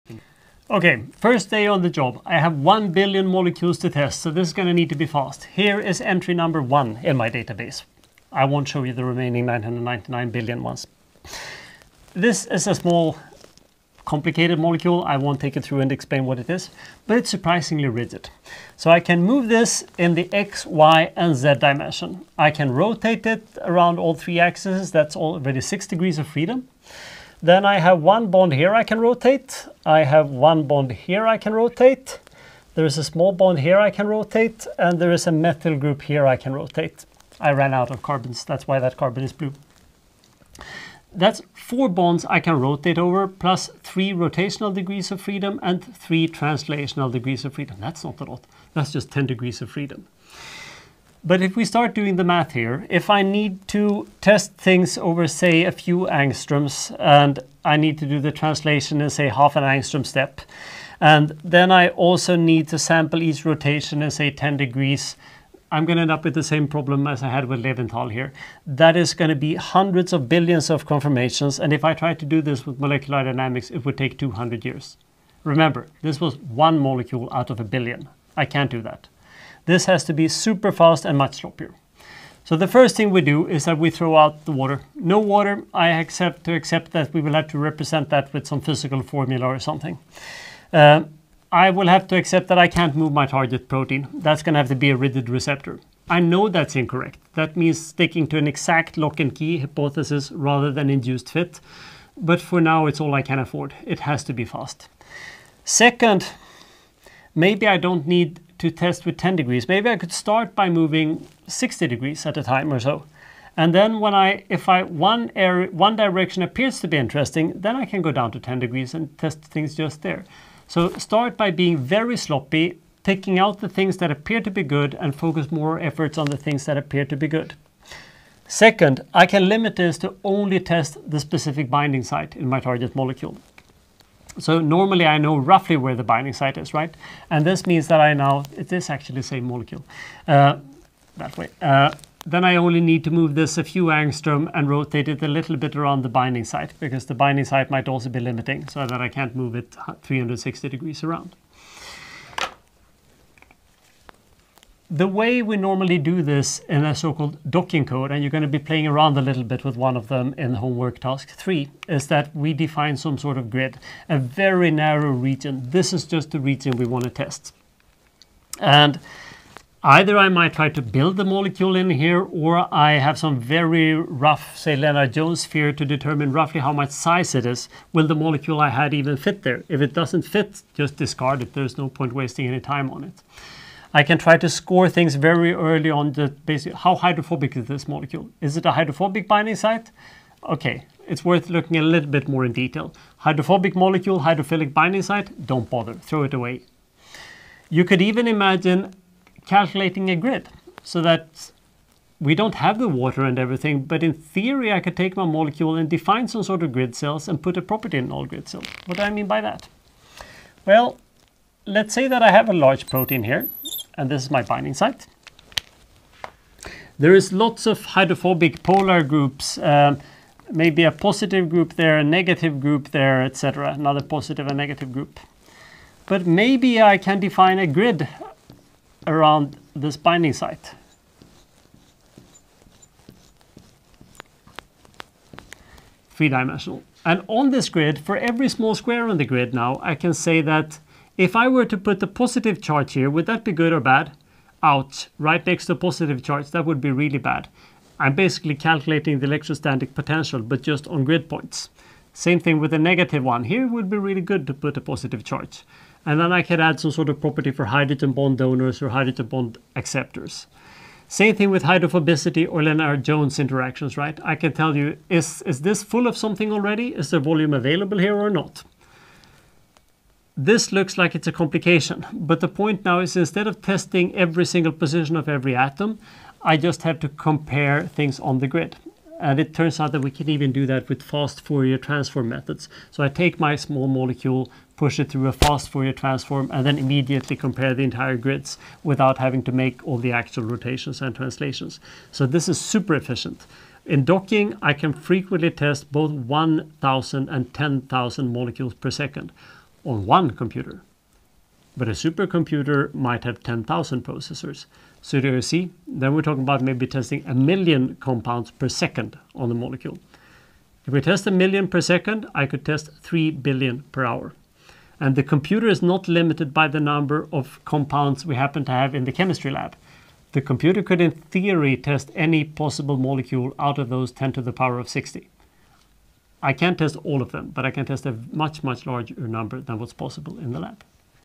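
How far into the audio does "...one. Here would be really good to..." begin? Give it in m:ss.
4:13.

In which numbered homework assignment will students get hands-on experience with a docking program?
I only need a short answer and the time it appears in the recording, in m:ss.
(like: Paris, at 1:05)
homework task 3, at 2:40.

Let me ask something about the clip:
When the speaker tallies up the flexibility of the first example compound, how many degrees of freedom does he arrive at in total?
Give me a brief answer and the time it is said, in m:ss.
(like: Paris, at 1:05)
10, at 0:49.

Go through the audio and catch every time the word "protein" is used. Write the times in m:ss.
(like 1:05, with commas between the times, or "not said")
1:33, 3:32.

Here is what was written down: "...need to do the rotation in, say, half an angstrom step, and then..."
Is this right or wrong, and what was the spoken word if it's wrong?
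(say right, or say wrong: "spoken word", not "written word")
wrong: "translation", not "rotation".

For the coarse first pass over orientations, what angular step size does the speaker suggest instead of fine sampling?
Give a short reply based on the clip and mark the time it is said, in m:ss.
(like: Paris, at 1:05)
60 degrees, at 1:51.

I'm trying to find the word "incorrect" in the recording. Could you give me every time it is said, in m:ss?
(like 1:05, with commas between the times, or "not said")
1:36.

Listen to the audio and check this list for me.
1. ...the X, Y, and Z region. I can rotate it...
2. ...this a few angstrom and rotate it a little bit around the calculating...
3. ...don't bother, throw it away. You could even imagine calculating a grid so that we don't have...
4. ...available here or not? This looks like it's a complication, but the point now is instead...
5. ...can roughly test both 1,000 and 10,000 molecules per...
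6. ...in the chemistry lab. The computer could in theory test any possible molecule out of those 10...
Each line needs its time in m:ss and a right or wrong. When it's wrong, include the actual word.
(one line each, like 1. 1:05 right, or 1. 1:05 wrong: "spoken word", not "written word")
1. 0:20 wrong: "dimension", not "region"
2. 2:23 wrong: "binding", not "calculating"
3. 3:15 right
4. 4:27 right
5. 4:54 wrong: "frequently", not "roughly"
6. 5:18 right.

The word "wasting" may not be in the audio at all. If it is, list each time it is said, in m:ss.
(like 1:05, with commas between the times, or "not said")
3:02.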